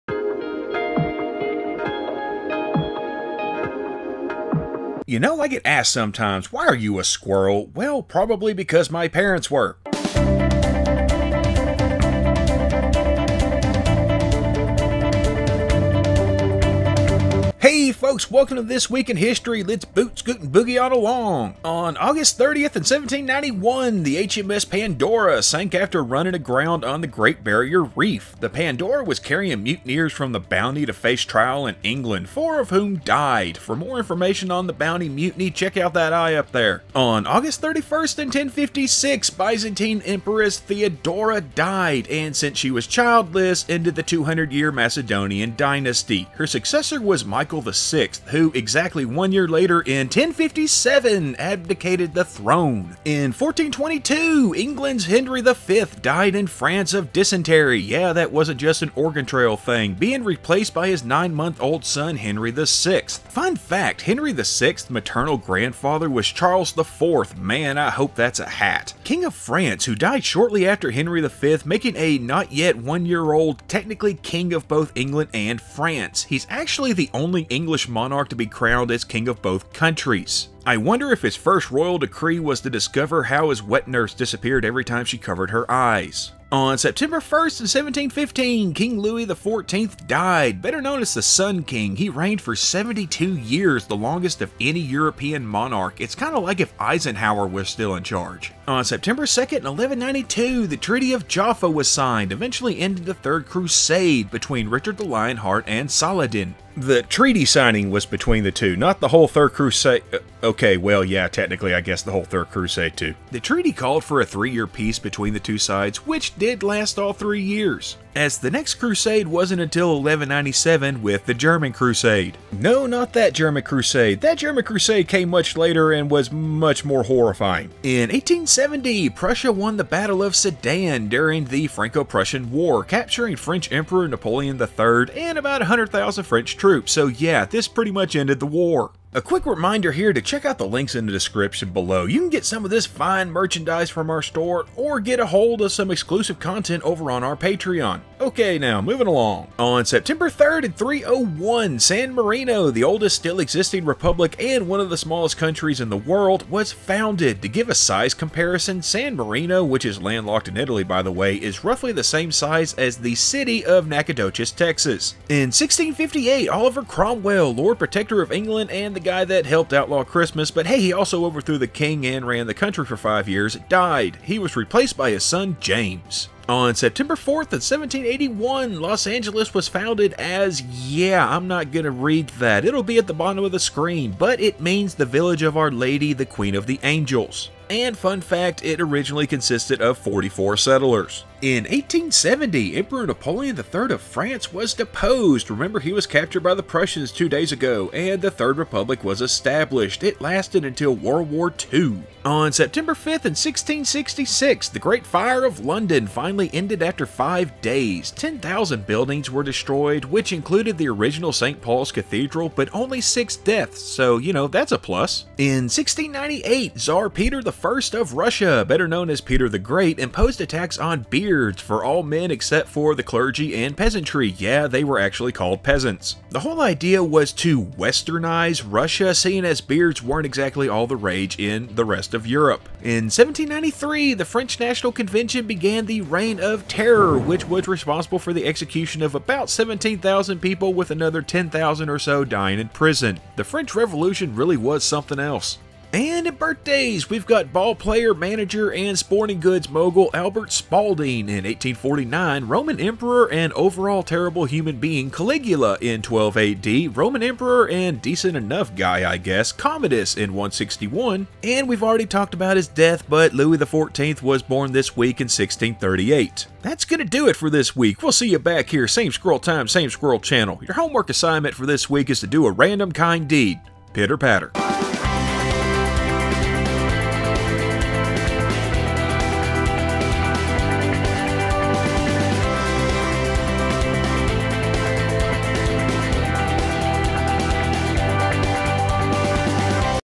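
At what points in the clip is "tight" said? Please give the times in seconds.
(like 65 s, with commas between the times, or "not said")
not said.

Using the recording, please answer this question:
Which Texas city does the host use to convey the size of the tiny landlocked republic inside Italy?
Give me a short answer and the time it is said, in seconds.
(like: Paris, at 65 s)
Nacogdoches, at 163 s.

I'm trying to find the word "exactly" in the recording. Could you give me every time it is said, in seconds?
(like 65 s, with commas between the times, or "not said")
48 s, 230 s.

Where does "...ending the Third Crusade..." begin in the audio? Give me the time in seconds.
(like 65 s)
102 s.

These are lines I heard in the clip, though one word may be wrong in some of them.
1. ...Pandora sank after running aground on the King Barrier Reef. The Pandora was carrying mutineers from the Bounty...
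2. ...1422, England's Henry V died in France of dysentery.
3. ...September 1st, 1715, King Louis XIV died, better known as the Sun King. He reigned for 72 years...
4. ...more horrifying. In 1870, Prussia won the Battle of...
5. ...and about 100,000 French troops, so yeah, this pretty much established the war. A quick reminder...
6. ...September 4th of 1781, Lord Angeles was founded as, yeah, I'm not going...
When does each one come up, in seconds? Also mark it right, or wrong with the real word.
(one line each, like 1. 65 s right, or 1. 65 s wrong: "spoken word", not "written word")
1. 24 s wrong: "Great", not "King"
2. 53 s right
3. 86 s right
4. 126 s right
5. 135 s wrong: "ended", not "established"
6. 176 s wrong: "Los", not "Lord".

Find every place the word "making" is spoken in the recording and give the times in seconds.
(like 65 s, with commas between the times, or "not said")
71 s.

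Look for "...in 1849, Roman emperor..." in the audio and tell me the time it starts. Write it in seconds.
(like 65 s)
251 s.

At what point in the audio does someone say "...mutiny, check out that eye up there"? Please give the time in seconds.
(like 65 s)
35 s.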